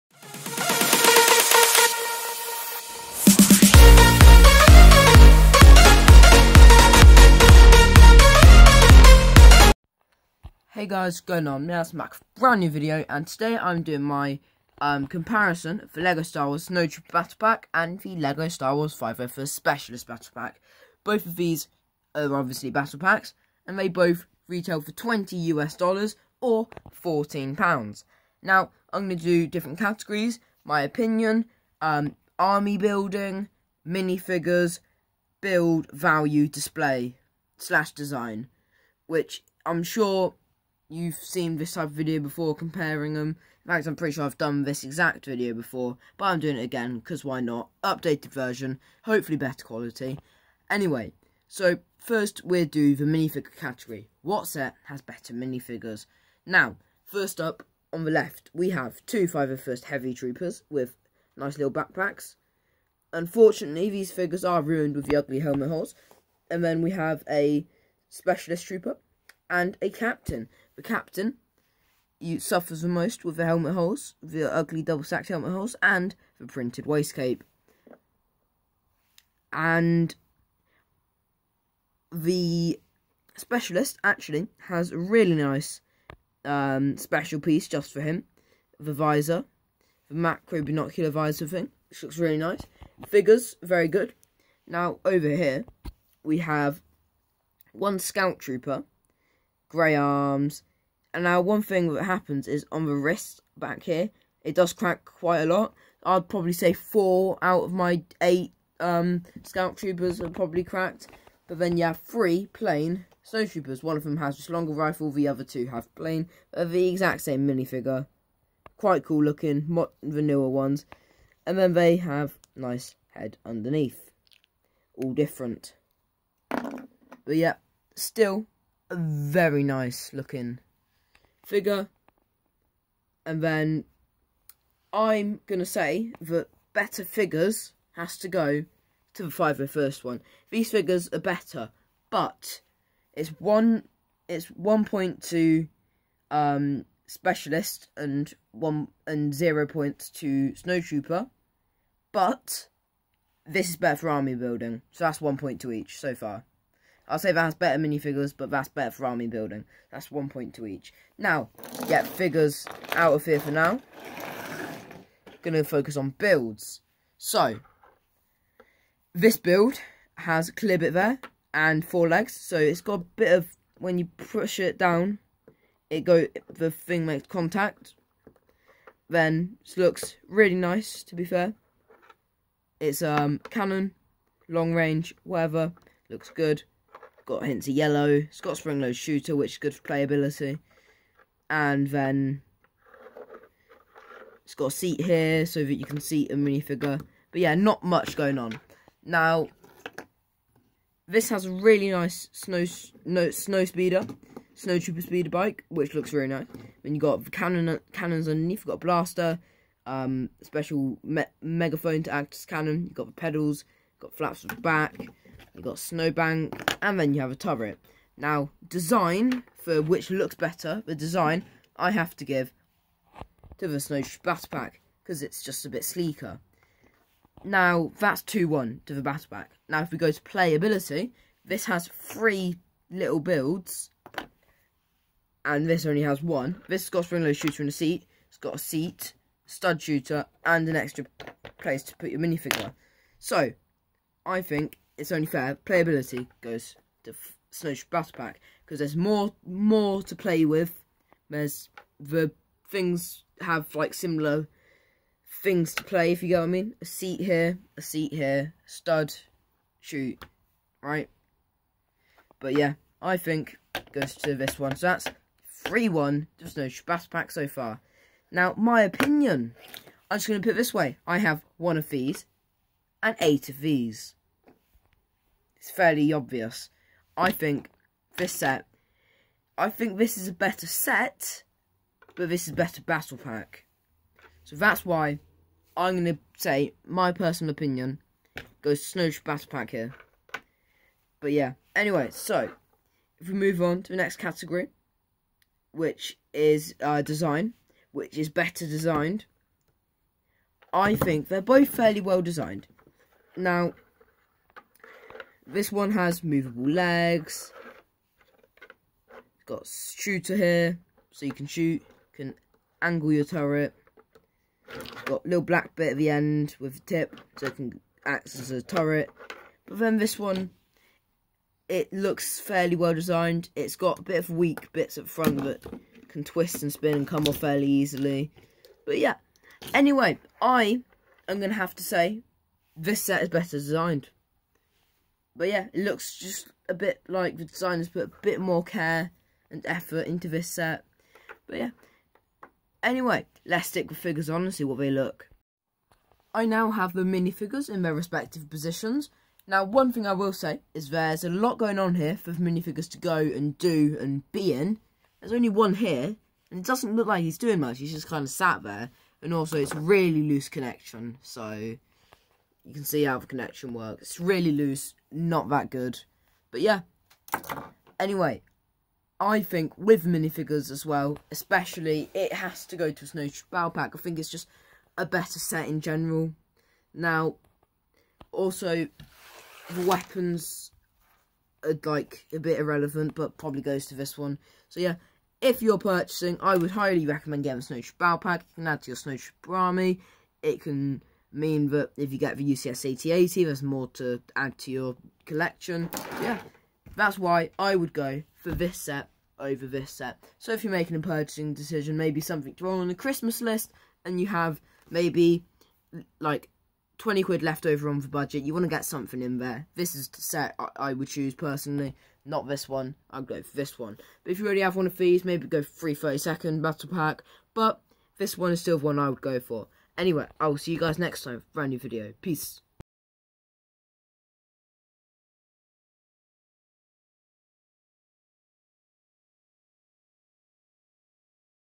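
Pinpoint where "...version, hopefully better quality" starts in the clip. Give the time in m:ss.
0:48.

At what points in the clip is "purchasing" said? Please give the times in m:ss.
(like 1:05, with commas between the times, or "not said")
6:25, 6:40.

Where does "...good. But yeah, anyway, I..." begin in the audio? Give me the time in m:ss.
6:05.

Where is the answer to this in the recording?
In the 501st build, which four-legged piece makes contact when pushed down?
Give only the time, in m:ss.
2:50.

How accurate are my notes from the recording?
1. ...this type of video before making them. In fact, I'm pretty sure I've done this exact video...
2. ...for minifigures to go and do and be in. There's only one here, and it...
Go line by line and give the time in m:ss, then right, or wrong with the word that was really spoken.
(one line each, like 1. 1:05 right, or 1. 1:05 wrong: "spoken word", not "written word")
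1. 0:41 wrong: "comparing", not "making"
2. 5:52 right.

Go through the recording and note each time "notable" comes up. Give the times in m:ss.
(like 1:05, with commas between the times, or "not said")
not said.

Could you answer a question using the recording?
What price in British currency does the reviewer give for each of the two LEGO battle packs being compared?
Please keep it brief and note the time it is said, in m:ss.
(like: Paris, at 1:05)
14 pounds, at 0:26.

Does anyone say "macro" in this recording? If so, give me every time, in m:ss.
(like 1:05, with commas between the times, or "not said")
1:30.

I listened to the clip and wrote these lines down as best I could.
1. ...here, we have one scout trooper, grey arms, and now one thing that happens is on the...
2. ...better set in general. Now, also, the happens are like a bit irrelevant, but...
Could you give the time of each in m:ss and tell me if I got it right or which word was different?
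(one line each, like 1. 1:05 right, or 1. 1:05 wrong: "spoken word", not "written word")
1. 1:35 right
2. 6:15 wrong: "weapons", not "happens".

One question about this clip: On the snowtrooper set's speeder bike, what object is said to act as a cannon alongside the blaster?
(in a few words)
Megaphone.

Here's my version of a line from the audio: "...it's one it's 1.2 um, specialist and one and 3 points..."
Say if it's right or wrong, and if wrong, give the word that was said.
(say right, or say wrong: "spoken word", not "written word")
wrong: "0", not "3".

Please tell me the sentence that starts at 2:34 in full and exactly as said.
So that's 1 point to each so far.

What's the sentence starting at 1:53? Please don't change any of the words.
One of them has just longer rifle, the other two have plain.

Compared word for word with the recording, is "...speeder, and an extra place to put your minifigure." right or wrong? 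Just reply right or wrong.
wrong.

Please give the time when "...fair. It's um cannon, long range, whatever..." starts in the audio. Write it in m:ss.
3:01.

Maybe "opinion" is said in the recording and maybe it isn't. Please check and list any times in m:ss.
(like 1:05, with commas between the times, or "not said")
0:30, 4:28, 4:47.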